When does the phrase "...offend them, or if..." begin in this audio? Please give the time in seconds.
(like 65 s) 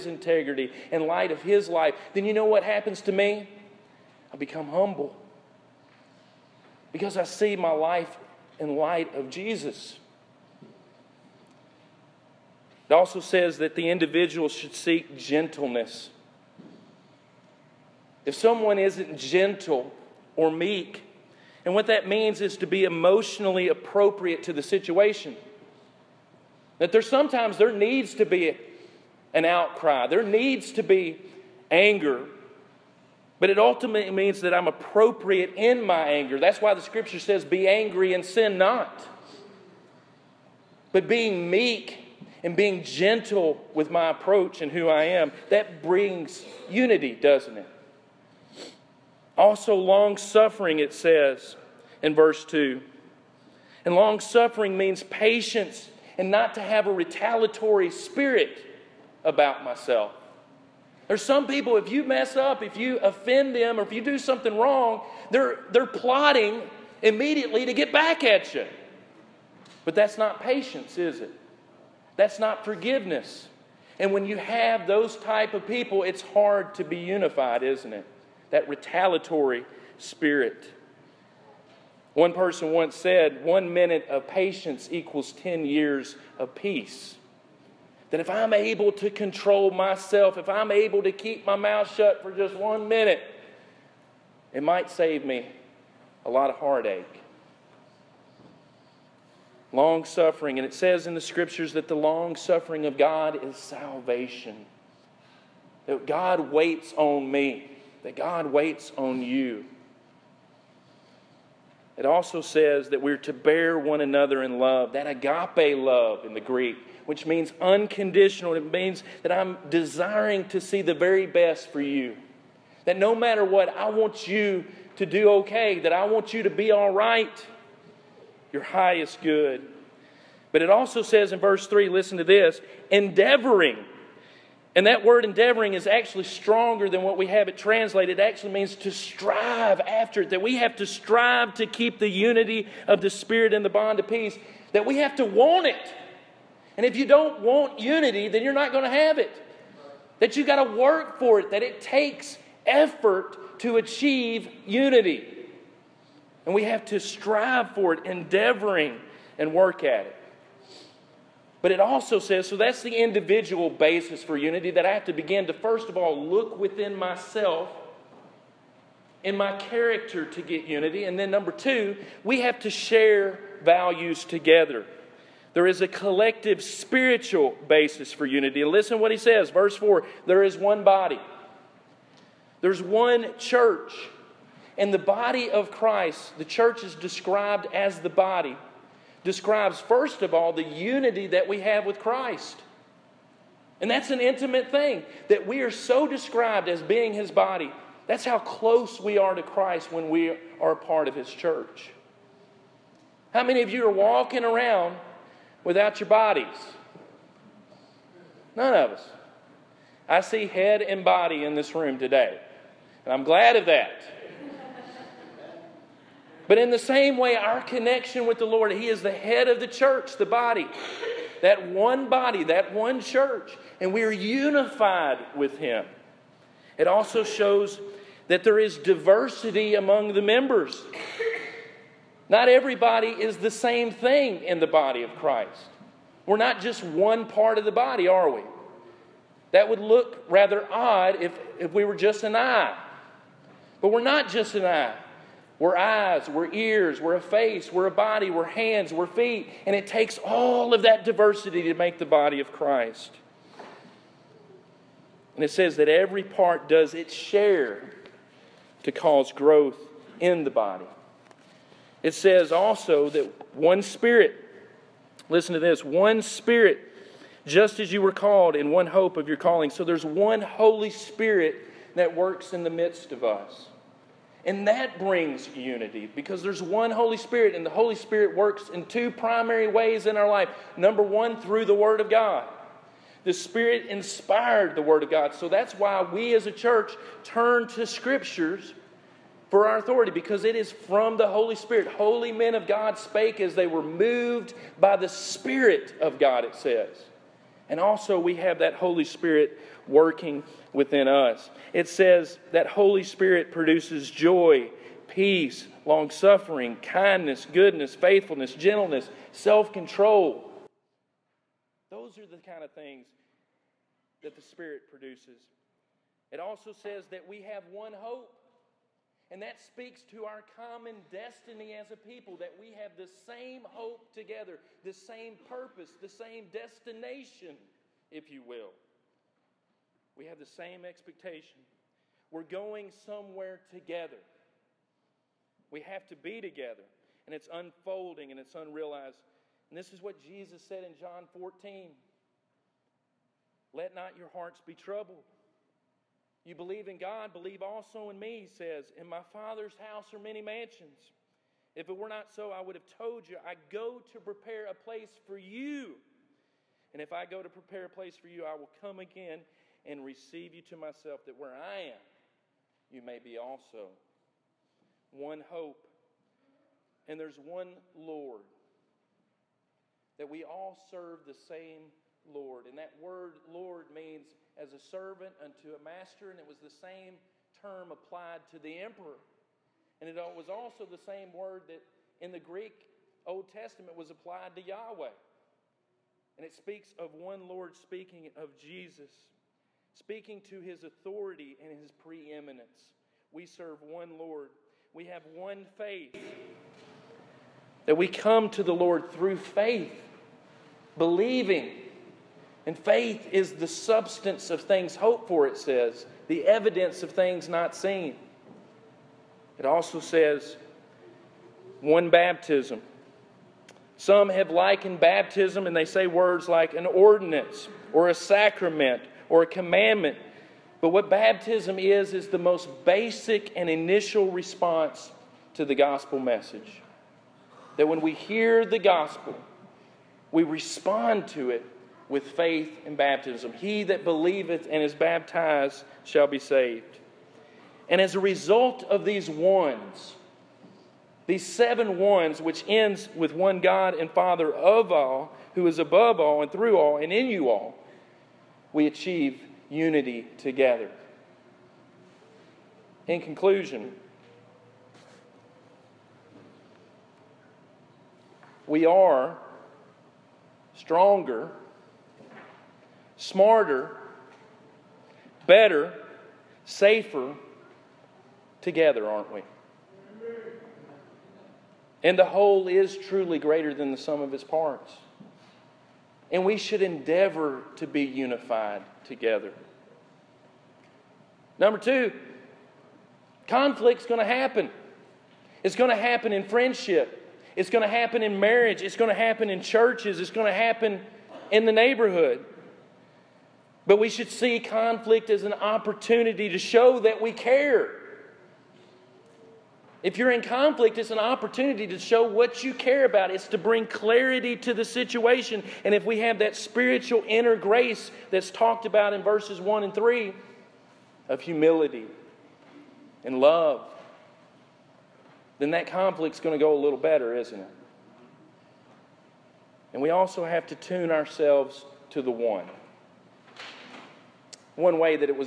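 62 s.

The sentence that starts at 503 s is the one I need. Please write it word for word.
It's to bring clarity to the situation.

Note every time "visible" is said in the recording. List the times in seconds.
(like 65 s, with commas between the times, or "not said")
not said.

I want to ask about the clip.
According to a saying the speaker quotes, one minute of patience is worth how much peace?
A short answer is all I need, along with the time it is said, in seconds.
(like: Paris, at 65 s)
10 years, at 85 s.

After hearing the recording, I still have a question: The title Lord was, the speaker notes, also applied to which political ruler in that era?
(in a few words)
the emperor.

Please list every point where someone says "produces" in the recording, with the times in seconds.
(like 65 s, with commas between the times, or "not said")
303 s, 314 s.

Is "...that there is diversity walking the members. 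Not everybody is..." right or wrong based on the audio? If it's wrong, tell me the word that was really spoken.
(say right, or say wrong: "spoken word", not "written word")
wrong: "among", not "walking".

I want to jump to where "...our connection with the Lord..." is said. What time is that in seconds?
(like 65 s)
217 s.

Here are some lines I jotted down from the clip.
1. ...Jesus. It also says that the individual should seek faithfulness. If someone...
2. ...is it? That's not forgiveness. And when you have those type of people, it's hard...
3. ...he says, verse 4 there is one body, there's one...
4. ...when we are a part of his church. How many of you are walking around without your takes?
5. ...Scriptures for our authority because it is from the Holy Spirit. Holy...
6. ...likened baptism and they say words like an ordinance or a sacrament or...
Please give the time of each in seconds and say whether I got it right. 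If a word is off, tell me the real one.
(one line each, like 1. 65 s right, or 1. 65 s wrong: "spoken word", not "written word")
1. 9 s wrong: "gentleness", not "faithfulness"
2. 70 s right
3. 179 s right
4. 199 s wrong: "bodies", not "takes"
5. 287 s right
6. 414 s right.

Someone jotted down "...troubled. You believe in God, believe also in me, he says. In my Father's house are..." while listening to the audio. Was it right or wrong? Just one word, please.
right.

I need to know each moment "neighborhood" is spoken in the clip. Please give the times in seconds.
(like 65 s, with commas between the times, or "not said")
491 s.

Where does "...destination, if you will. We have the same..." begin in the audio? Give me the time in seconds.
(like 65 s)
326 s.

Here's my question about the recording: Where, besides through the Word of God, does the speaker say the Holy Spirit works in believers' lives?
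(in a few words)
within us.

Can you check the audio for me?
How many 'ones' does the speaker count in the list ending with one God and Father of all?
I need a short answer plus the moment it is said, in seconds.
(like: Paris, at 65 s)
7, at 441 s.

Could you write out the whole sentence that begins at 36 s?
That's why the scripture says, Be angry and sin not.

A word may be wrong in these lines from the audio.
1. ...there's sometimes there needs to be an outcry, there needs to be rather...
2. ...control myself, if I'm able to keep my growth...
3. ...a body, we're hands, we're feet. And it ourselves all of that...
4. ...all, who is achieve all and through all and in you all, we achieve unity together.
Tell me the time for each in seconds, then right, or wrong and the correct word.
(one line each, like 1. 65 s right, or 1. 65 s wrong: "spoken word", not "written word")
1. 26 s wrong: "anger", not "rather"
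2. 89 s wrong: "mouth", not "growth"
3. 247 s wrong: "takes", not "ourselves"
4. 444 s wrong: "above", not "achieve".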